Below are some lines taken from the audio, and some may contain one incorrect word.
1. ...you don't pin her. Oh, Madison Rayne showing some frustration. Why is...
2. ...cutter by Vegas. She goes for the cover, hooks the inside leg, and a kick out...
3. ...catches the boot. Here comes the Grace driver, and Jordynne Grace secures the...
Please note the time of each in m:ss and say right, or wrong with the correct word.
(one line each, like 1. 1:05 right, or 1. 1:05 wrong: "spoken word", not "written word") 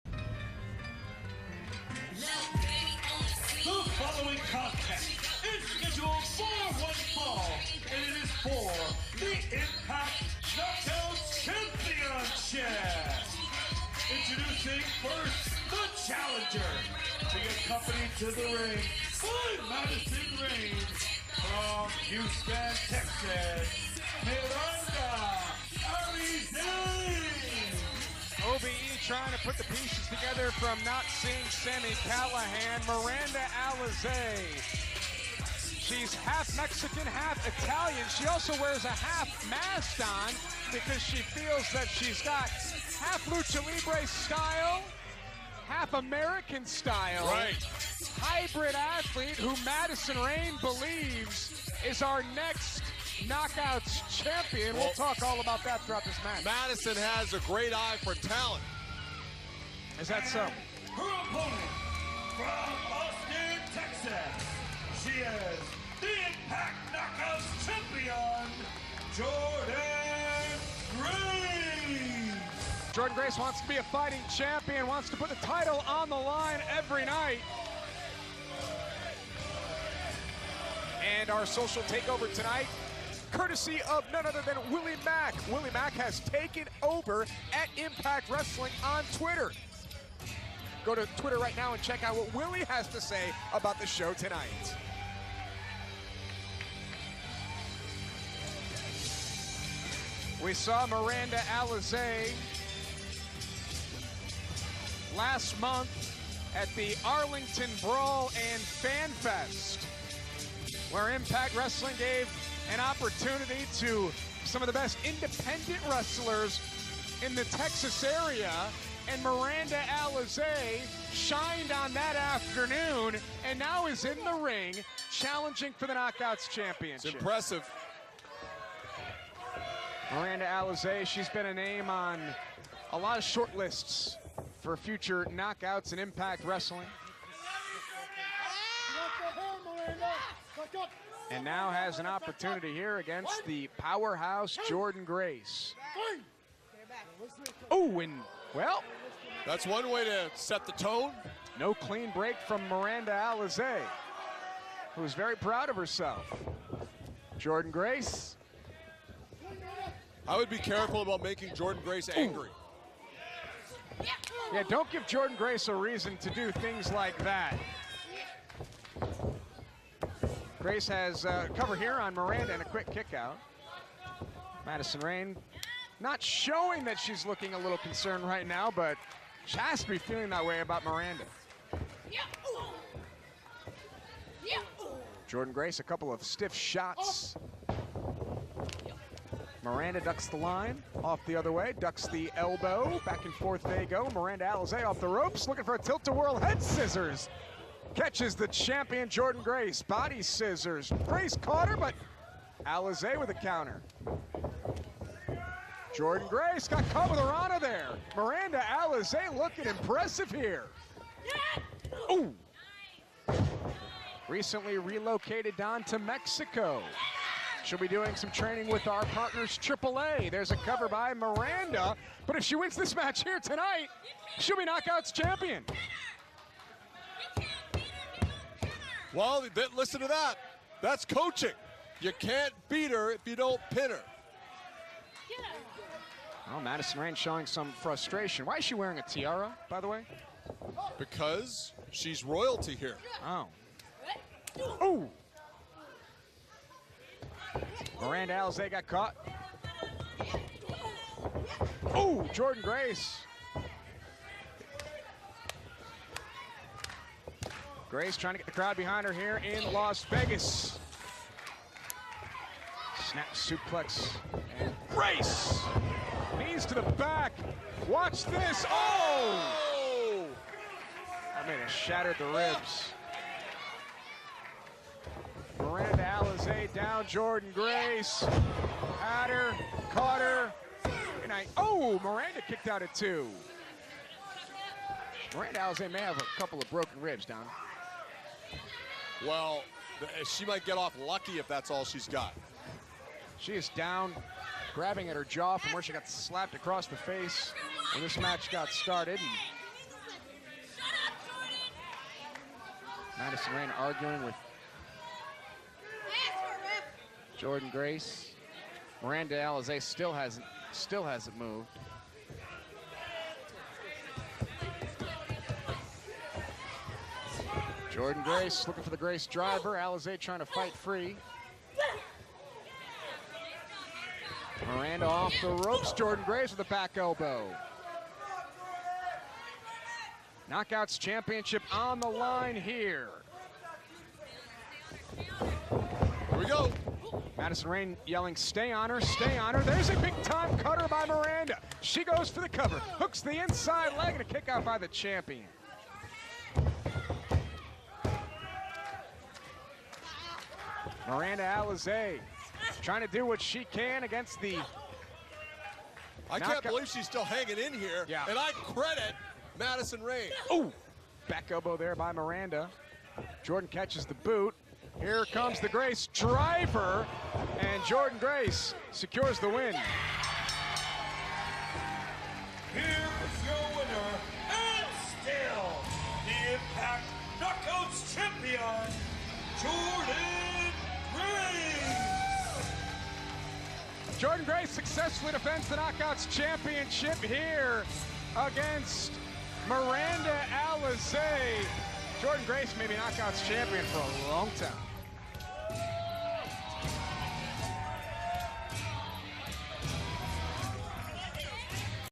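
1. 3:53 right
2. 5:40 wrong: "Miranda", not "Vegas"
3. 6:03 right.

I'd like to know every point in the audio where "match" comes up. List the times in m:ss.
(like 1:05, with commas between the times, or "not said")
0:56, 3:42, 4:58.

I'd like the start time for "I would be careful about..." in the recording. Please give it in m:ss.
2:40.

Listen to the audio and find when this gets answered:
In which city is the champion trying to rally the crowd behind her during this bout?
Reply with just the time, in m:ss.
4:19.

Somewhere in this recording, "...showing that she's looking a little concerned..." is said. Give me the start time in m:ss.
2:56.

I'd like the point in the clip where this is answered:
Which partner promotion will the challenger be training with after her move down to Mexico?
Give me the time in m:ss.
3:39.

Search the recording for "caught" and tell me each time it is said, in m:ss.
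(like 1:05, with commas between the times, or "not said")
3:21, 3:26, 4:08.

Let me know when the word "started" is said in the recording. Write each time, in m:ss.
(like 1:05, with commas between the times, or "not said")
4:58.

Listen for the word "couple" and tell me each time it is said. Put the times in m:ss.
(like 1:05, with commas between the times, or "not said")
3:05, 4:46.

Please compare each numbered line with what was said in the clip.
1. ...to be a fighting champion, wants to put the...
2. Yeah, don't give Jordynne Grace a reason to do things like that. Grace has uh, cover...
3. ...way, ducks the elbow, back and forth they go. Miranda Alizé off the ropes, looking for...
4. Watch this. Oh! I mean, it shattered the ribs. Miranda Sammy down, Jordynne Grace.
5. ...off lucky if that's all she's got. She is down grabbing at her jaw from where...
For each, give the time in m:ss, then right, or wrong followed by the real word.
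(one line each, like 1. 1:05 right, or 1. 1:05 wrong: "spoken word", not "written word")
1. 1:13 right
2. 2:44 right
3. 3:11 right
4. 4:27 wrong: "Alizé", not "Sammy"
5. 4:50 right.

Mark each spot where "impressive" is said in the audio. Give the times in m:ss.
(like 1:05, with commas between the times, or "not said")
2:07, 3:29.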